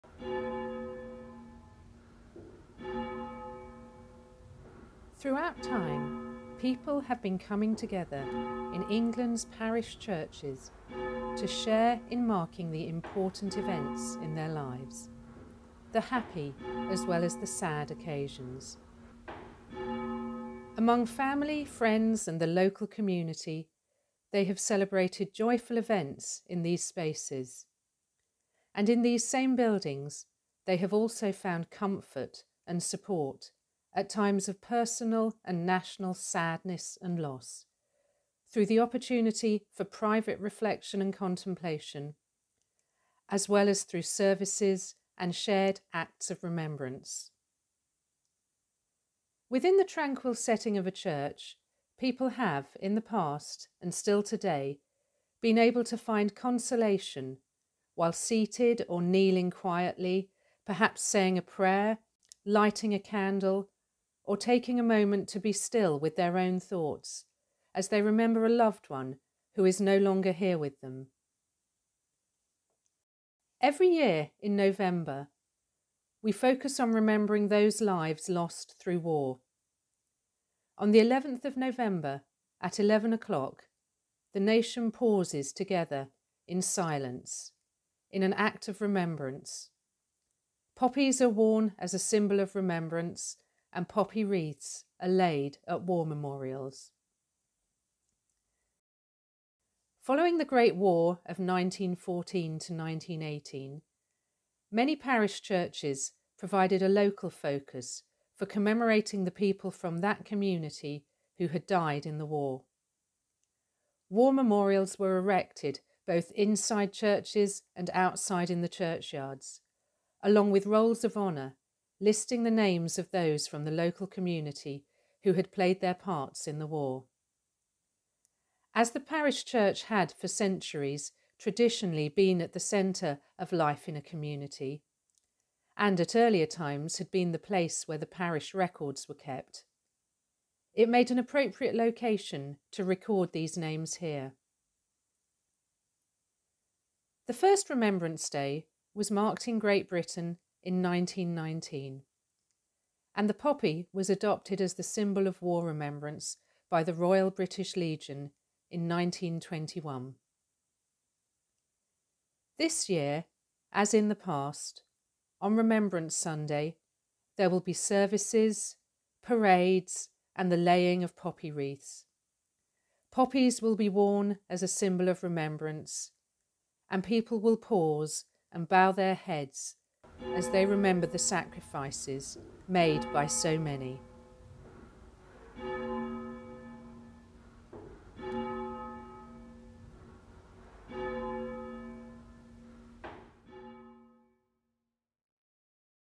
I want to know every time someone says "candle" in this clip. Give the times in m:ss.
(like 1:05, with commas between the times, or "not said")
1:02.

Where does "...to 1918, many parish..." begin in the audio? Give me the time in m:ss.
1:42.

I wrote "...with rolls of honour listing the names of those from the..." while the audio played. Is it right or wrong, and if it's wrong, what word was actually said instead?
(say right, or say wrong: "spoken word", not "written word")
right.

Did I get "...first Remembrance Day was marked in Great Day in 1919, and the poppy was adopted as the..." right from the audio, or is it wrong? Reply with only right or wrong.
wrong.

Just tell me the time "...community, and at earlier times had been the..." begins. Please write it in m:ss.
2:14.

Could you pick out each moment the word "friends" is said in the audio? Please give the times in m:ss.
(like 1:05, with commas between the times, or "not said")
0:21.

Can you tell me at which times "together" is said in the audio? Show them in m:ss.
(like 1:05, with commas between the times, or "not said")
0:07, 1:25.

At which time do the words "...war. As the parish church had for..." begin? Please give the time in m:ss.
2:06.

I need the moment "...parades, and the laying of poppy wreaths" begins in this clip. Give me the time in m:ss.
2:49.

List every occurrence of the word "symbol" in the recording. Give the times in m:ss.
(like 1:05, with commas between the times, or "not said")
1:31, 2:34, 2:54.